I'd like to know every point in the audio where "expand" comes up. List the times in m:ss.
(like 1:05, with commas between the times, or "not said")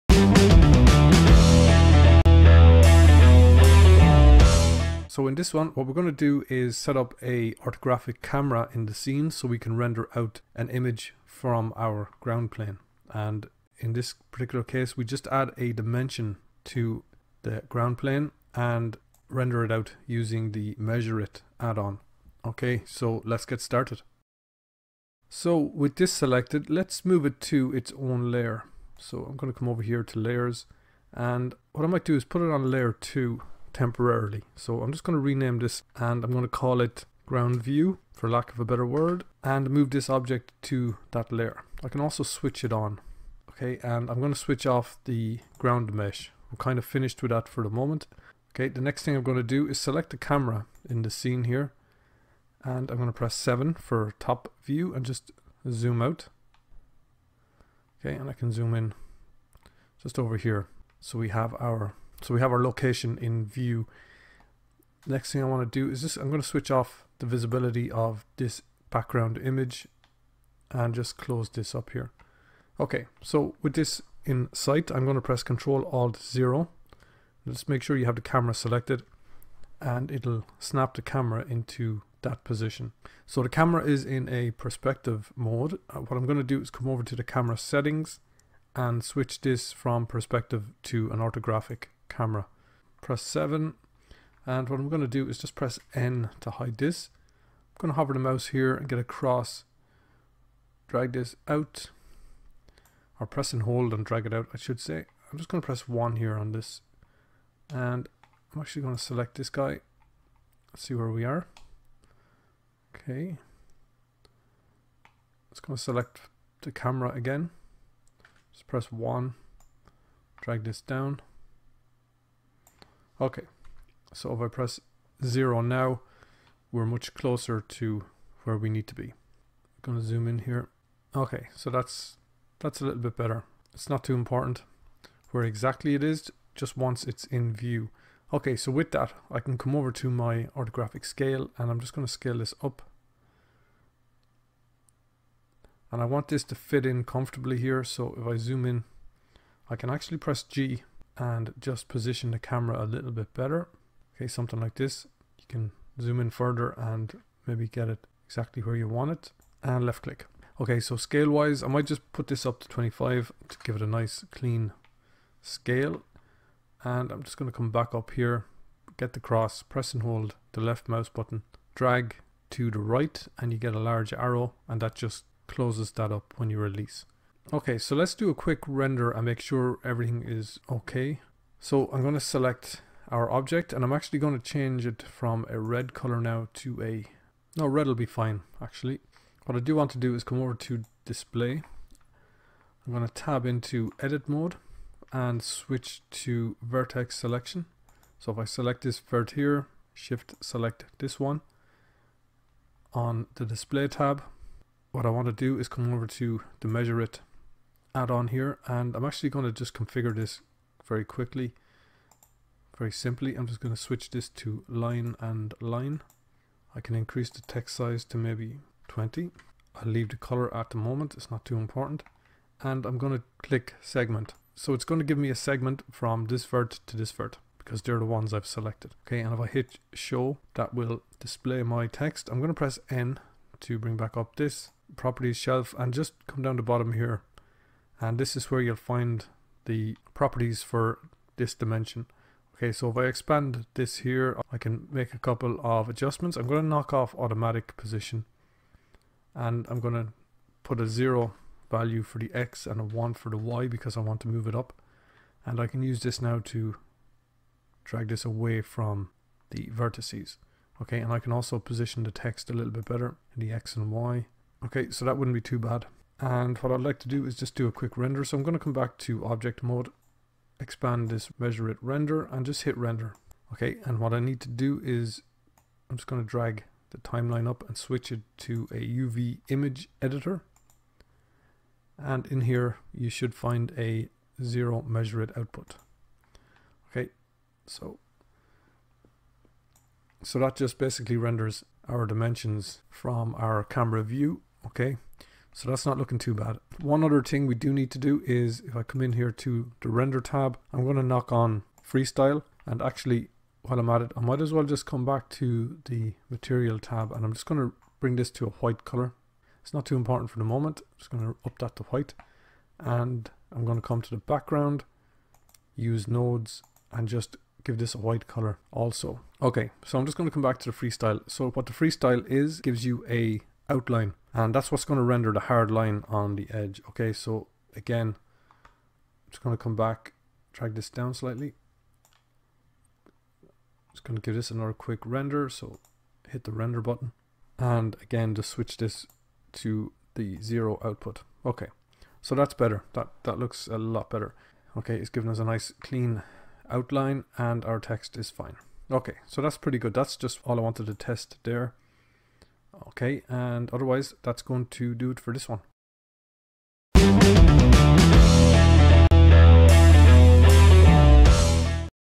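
4:03, 4:30.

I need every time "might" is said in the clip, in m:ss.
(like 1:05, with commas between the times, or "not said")
0:31, 2:41, 5:04.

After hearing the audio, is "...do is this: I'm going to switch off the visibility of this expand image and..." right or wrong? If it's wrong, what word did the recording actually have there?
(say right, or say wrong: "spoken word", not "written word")
wrong: "background", not "expand".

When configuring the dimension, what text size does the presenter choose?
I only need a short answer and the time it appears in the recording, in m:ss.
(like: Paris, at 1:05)
20, at 3:38.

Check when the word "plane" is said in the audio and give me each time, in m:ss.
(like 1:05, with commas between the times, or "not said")
0:12, 0:17.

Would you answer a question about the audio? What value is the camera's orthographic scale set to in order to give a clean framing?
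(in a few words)
25.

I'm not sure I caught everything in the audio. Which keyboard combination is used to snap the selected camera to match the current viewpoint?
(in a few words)
Control Alt 0.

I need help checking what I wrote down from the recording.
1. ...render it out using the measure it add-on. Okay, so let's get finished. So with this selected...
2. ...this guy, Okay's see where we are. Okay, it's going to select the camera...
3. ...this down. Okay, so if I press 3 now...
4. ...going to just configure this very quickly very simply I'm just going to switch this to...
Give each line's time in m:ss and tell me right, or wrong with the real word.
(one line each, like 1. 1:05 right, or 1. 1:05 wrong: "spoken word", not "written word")
1. 0:19 wrong: "started", not "finished"
2. 1:49 wrong: "Let", not "Okay"
3. 2:00 wrong: "0", not "3"
4. 3:29 right.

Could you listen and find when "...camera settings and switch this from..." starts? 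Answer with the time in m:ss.
1:27.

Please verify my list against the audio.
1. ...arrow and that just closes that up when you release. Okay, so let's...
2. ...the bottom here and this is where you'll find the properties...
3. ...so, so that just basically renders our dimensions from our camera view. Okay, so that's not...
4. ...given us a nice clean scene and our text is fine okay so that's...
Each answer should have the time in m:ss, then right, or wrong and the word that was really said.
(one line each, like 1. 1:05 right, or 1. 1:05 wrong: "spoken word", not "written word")
1. 2:54 right
2. 3:56 right
3. 4:47 right
4. 5:45 wrong: "outline", not "scene".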